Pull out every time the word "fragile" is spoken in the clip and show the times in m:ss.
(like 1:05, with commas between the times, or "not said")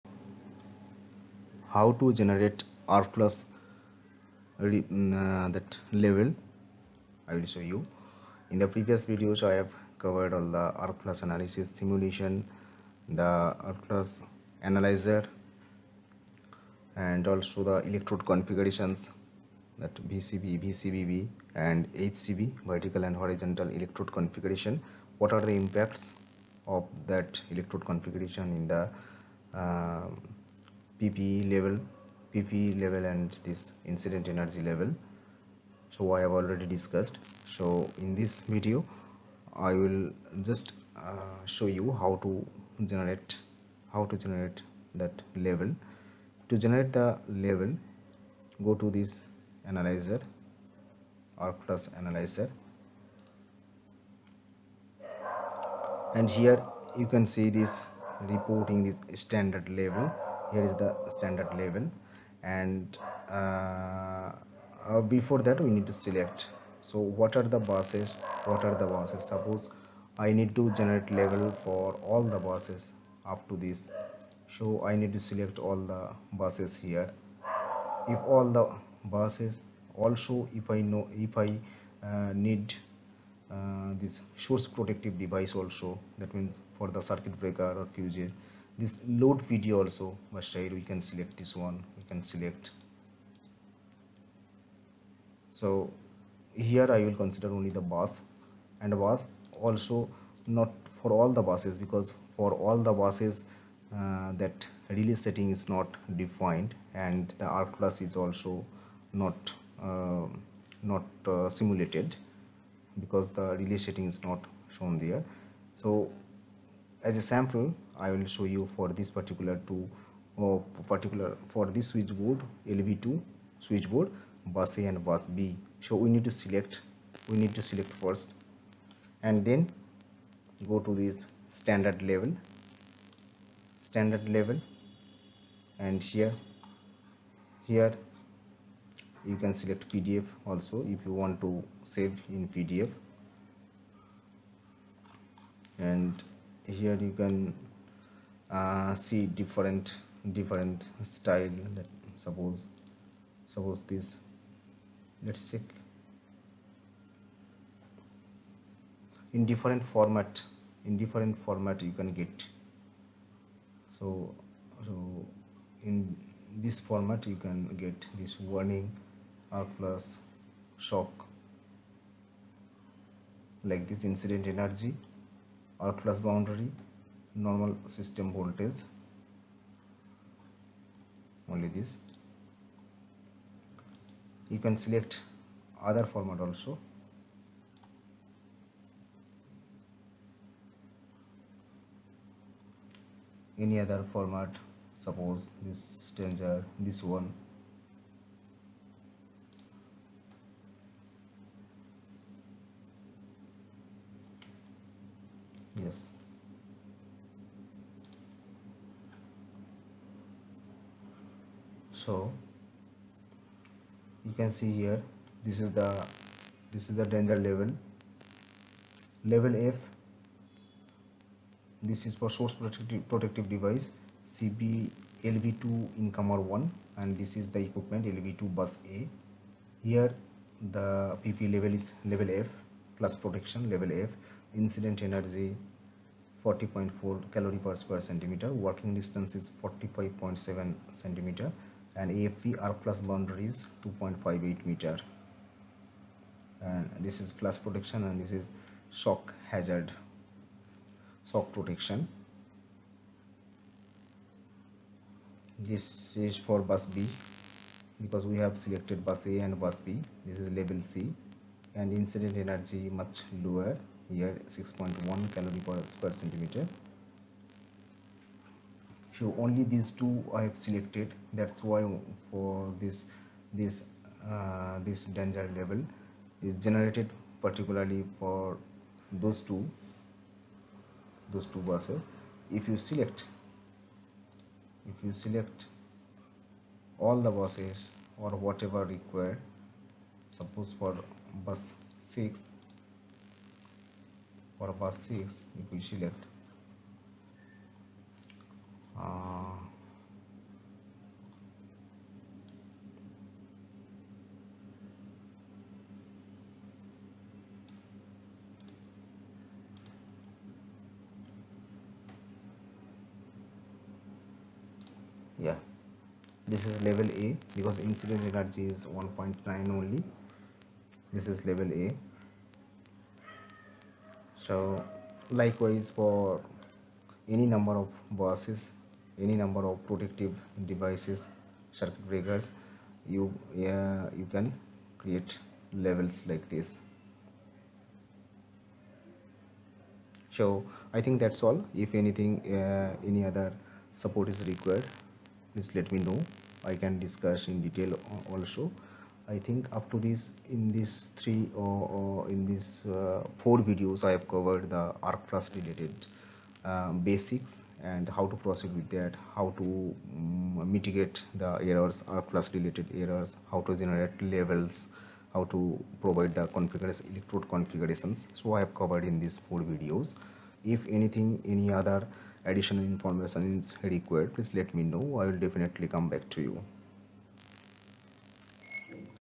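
not said.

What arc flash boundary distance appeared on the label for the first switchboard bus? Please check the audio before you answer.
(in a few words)
2.58 meters.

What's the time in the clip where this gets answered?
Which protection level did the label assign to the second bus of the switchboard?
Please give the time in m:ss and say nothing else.
4:20.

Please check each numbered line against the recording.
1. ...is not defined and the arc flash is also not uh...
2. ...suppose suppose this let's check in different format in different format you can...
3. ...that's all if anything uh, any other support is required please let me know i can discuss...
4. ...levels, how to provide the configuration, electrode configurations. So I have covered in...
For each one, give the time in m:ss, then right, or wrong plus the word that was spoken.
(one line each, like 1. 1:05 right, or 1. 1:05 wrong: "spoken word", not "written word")
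1. 1:45 right
2. 2:32 right
3. 5:41 right
4. 6:04 right.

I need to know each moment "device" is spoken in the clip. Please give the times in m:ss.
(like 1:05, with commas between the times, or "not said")
1:25, 3:43, 5:30.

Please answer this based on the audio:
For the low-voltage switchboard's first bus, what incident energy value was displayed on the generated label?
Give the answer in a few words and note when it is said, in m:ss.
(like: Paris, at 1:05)
40.4 cal/cm², at 3:56.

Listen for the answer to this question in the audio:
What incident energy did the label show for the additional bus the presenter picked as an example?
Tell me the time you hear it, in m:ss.
5:18.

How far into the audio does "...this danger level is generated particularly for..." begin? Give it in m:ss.
4:34.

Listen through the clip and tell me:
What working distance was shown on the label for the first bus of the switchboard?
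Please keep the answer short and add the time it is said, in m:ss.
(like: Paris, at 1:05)
45.7 cm, at 3:59.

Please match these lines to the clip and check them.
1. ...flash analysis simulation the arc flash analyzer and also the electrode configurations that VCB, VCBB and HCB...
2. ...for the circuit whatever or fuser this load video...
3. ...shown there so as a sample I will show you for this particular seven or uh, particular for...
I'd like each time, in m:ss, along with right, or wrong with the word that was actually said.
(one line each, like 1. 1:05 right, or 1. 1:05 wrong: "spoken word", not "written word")
1. 0:11 right
2. 1:26 wrong: "breaker", not "whatever"
3. 1:54 wrong: "two", not "seven".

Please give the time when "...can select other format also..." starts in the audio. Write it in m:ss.
3:04.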